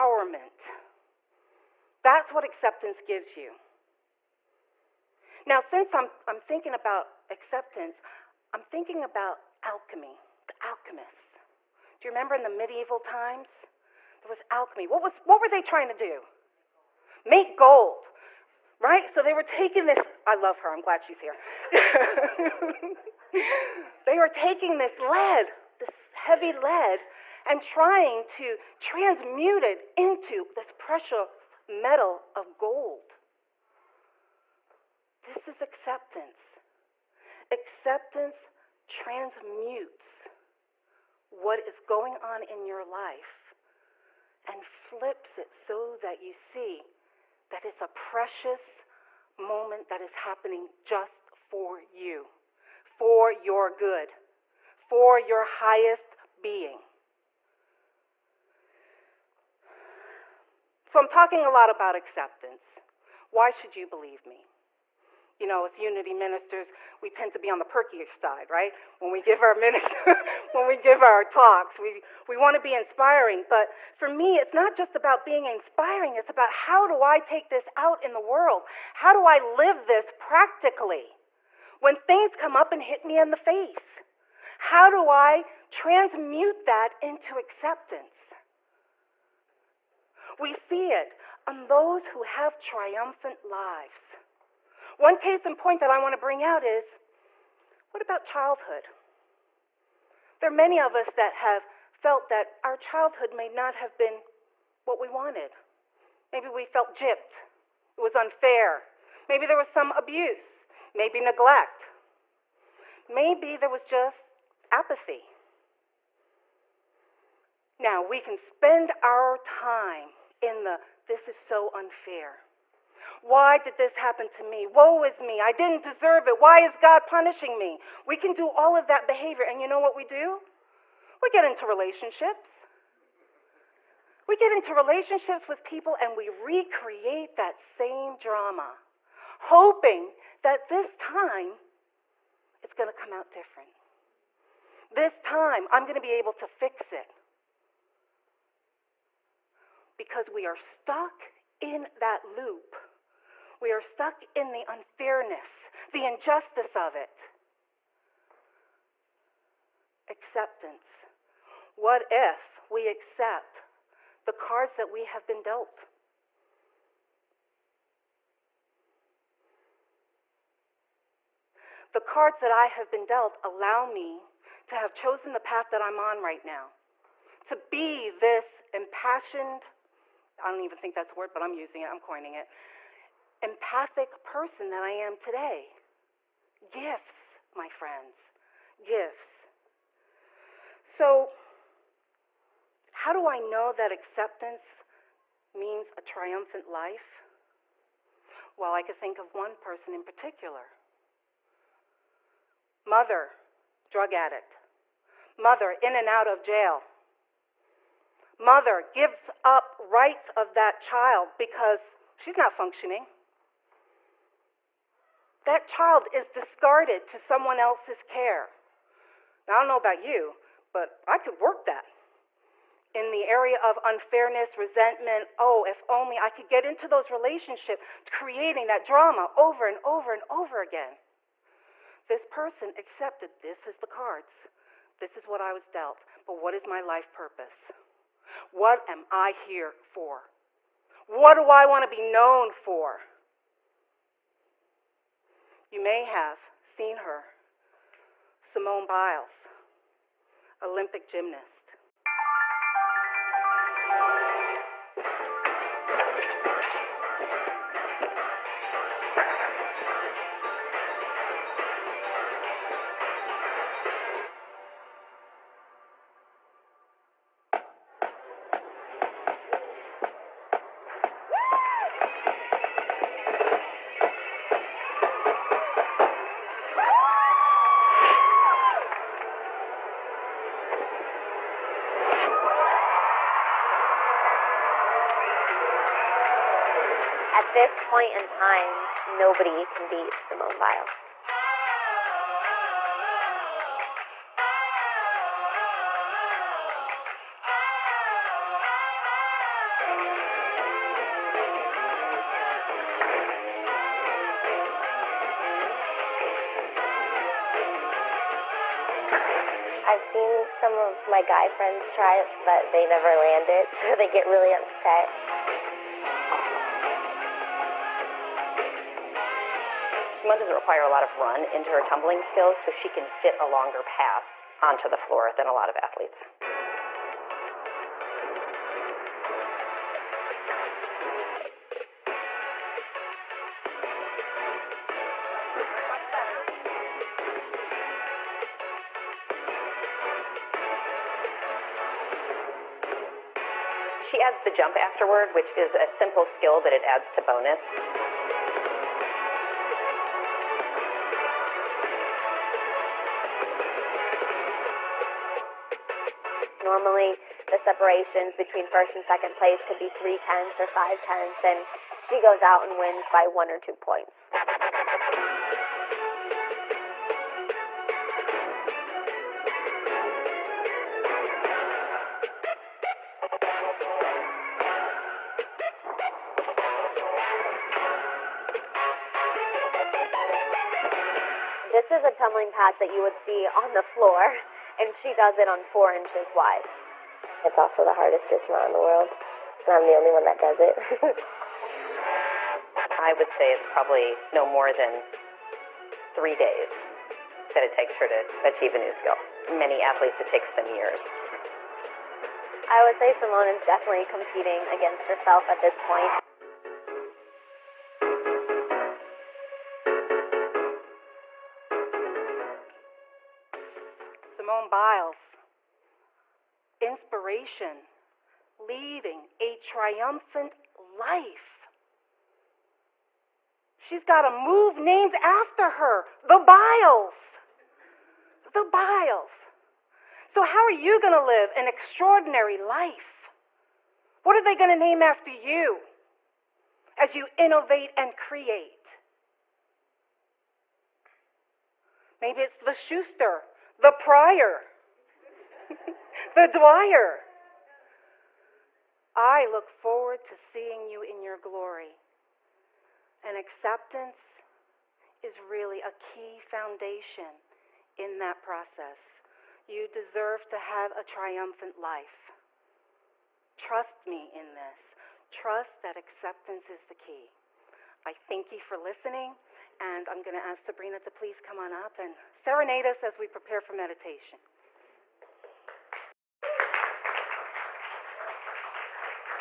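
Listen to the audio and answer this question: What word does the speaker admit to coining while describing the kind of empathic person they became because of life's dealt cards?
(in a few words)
impassioned.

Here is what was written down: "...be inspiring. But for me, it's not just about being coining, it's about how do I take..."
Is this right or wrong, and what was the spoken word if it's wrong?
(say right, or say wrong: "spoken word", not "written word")
wrong: "inspiring", not "coining".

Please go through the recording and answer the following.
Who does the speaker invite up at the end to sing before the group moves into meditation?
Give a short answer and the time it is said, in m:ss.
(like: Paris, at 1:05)
Sabrina, at 7:50.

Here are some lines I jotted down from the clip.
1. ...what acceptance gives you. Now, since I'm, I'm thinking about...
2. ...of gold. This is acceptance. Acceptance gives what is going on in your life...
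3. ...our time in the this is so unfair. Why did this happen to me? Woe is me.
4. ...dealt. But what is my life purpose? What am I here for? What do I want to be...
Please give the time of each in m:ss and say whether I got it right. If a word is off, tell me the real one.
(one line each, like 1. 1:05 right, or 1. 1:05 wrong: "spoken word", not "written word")
1. 0:02 right
2. 0:32 wrong: "transmutes", not "gives"
3. 1:59 right
4. 3:55 right.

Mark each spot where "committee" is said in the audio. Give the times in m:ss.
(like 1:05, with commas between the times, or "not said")
not said.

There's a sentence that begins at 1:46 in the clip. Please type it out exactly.
Maybe we felt gypped, it was unfair.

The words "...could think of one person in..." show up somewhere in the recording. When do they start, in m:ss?
3:18.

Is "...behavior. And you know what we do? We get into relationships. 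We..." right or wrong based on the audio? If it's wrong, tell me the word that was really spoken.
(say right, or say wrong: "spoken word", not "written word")
right.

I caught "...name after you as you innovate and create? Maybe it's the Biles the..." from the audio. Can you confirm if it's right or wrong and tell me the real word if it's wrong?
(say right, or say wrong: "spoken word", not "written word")
wrong: "Schuster", not "Biles".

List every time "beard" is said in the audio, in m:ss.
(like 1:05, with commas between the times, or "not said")
not said.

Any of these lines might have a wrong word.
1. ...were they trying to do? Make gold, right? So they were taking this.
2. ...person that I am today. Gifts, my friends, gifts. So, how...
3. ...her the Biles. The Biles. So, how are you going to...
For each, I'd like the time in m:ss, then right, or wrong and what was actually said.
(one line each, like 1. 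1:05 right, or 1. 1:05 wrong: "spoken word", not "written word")
1. 0:15 right
2. 3:04 right
3. 7:05 right.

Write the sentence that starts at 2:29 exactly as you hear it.
Because we are stuck in that loop we are stuck in the unfairness, the injustice of it.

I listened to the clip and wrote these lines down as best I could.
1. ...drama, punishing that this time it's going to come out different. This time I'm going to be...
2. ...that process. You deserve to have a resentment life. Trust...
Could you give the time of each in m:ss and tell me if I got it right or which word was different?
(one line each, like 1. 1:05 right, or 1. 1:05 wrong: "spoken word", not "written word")
1. 2:18 wrong: "hoping", not "punishing"
2. 7:38 wrong: "triumphant", not "resentment".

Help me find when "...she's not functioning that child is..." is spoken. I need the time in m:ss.
3:32.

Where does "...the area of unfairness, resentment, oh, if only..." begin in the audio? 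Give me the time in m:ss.
3:43.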